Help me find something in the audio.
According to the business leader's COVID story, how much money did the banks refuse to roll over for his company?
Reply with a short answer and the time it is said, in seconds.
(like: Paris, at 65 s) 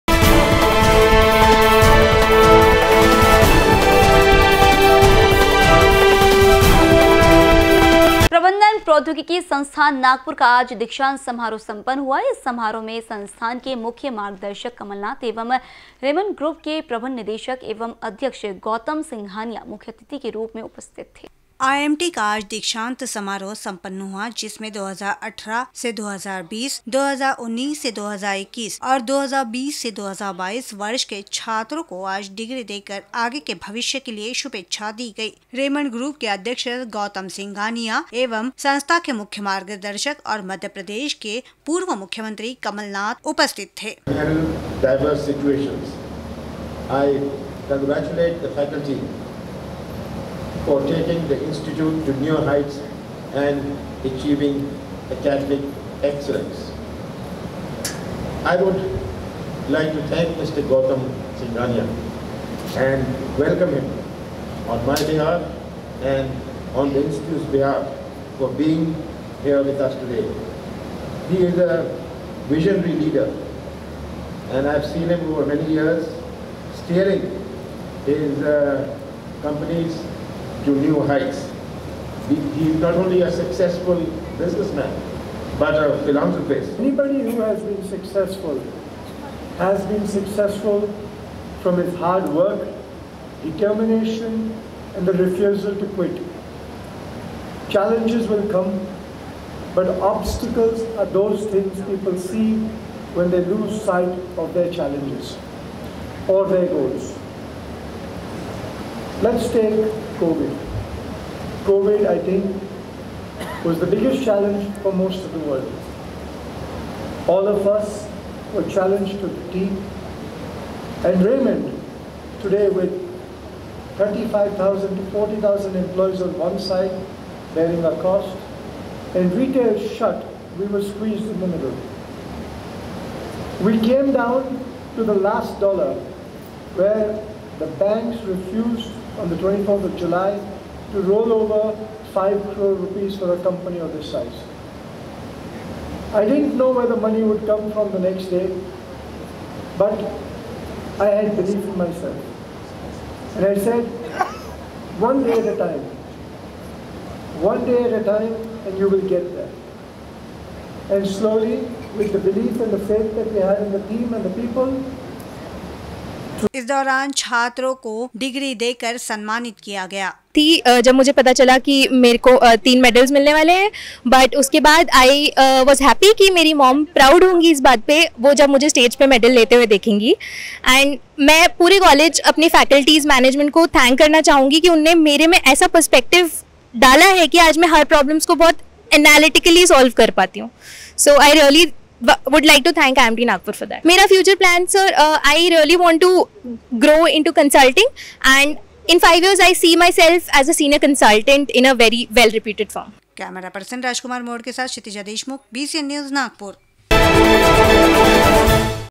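5 crore rupees, at 142 s.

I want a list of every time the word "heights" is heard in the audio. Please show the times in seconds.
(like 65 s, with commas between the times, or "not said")
52 s, 81 s.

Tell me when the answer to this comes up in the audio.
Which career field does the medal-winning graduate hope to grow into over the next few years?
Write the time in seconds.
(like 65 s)
197 s.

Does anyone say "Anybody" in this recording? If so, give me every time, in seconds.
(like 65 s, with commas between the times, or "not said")
86 s.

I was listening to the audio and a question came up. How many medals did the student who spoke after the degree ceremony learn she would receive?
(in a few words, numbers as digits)
3.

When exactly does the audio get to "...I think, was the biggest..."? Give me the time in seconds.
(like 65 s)
112 s.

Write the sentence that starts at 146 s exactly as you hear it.
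I didn't know where the money would come from the next day, but I had belief in myself.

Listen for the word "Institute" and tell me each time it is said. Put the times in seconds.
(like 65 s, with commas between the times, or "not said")
51 s, 67 s.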